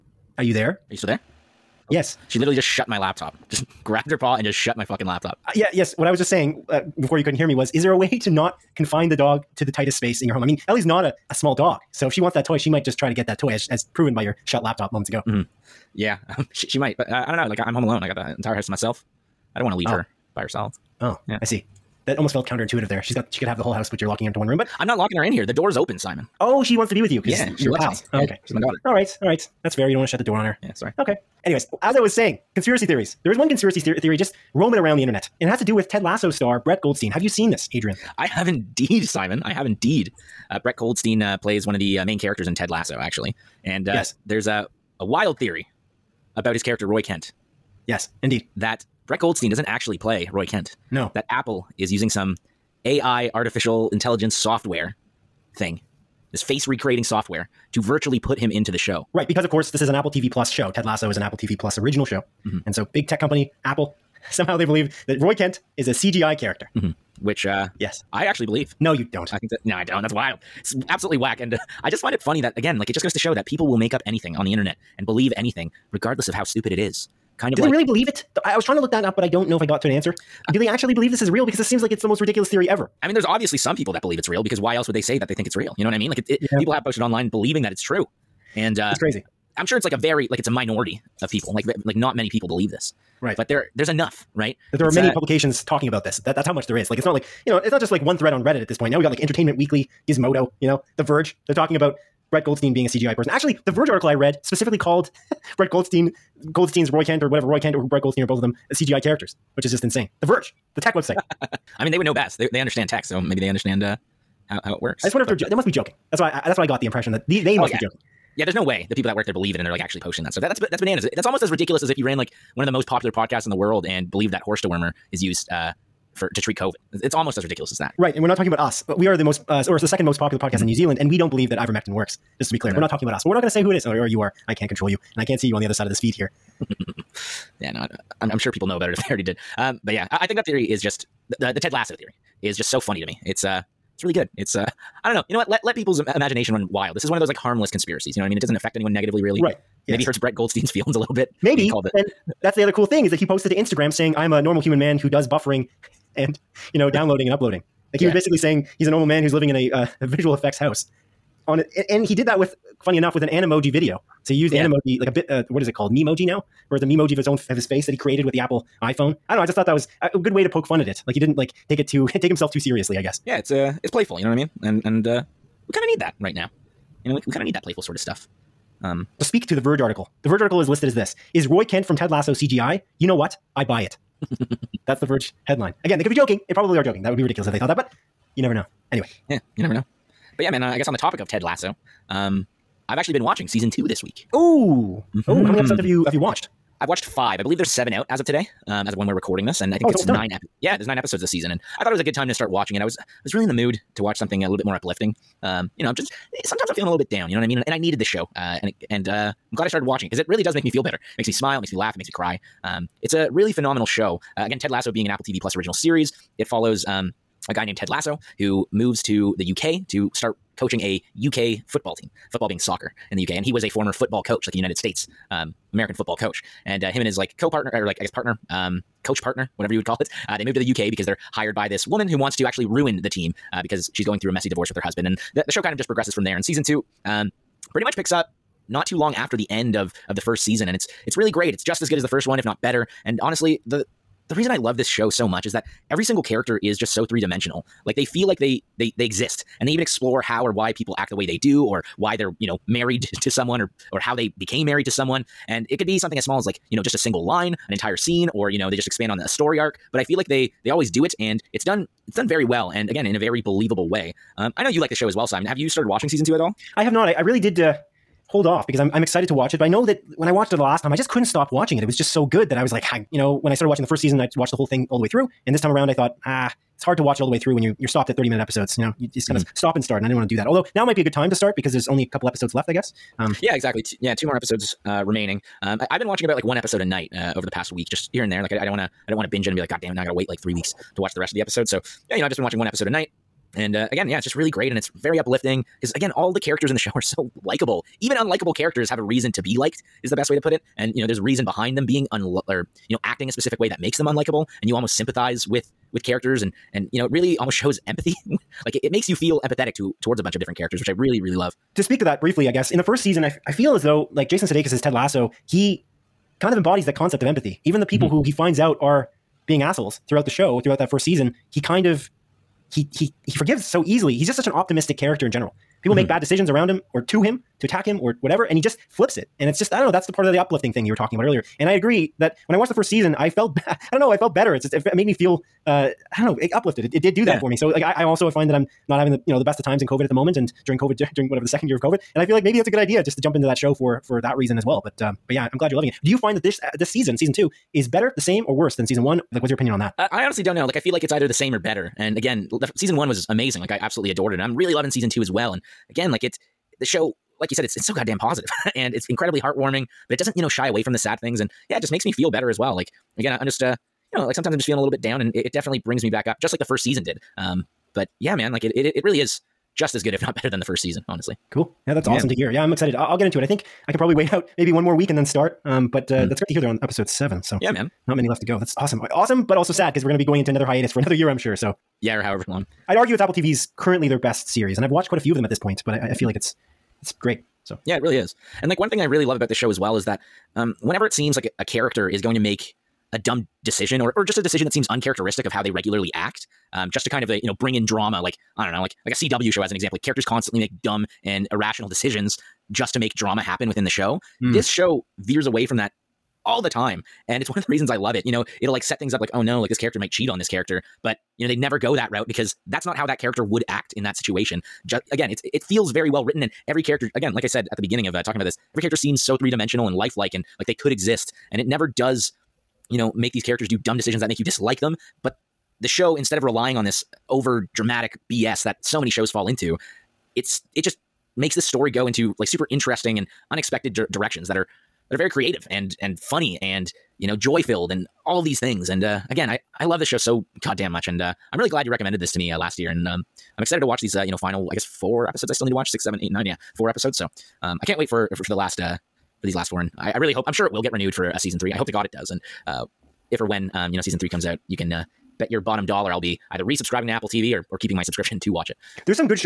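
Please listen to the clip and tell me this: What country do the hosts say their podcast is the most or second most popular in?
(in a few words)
New Zealand.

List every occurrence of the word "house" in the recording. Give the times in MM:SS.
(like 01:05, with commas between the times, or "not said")
00:18, 00:23, 02:40.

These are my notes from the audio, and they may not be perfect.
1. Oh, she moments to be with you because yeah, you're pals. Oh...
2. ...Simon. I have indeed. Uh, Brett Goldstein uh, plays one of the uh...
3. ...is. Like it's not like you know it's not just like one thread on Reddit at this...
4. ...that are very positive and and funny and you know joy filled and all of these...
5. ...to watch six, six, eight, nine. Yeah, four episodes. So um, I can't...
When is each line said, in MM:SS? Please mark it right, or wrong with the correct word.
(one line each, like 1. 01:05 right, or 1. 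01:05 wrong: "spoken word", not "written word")
1. 00:26 wrong: "wants", not "moments"
2. 00:39 right
3. 01:36 right
4. 07:15 wrong: "creative", not "positive"
5. 07:25 wrong: "seven", not "six".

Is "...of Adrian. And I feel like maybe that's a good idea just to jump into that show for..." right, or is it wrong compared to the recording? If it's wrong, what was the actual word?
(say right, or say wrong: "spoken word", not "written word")
wrong: "COVID", not "Adrian".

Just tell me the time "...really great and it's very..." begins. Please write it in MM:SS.
04:54.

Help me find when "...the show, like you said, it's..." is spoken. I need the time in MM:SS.
05:56.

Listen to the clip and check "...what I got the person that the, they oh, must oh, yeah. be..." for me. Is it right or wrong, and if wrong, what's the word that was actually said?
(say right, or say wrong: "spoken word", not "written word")
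wrong: "impression", not "person".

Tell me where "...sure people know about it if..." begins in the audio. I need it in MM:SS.
02:18.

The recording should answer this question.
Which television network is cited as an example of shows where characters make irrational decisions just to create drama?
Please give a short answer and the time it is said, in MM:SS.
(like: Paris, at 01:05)
CW, at 06:39.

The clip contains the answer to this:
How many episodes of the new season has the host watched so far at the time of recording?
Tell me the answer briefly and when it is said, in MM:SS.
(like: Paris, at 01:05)
5, at 03:17.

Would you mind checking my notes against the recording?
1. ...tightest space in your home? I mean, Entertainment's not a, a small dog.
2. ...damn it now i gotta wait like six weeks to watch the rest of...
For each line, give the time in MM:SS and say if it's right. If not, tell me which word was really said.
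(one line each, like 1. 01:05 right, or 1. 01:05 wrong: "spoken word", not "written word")
1. 00:09 wrong: "Ellie", not "Entertainment"
2. 04:49 wrong: "three", not "six".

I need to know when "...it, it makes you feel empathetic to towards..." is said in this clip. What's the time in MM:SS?
05:08.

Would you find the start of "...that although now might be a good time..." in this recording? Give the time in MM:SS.
04:40.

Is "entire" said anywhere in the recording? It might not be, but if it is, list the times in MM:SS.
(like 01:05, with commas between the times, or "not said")
00:18, 04:17.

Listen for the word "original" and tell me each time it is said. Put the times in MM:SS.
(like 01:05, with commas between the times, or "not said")
01:01, 03:35.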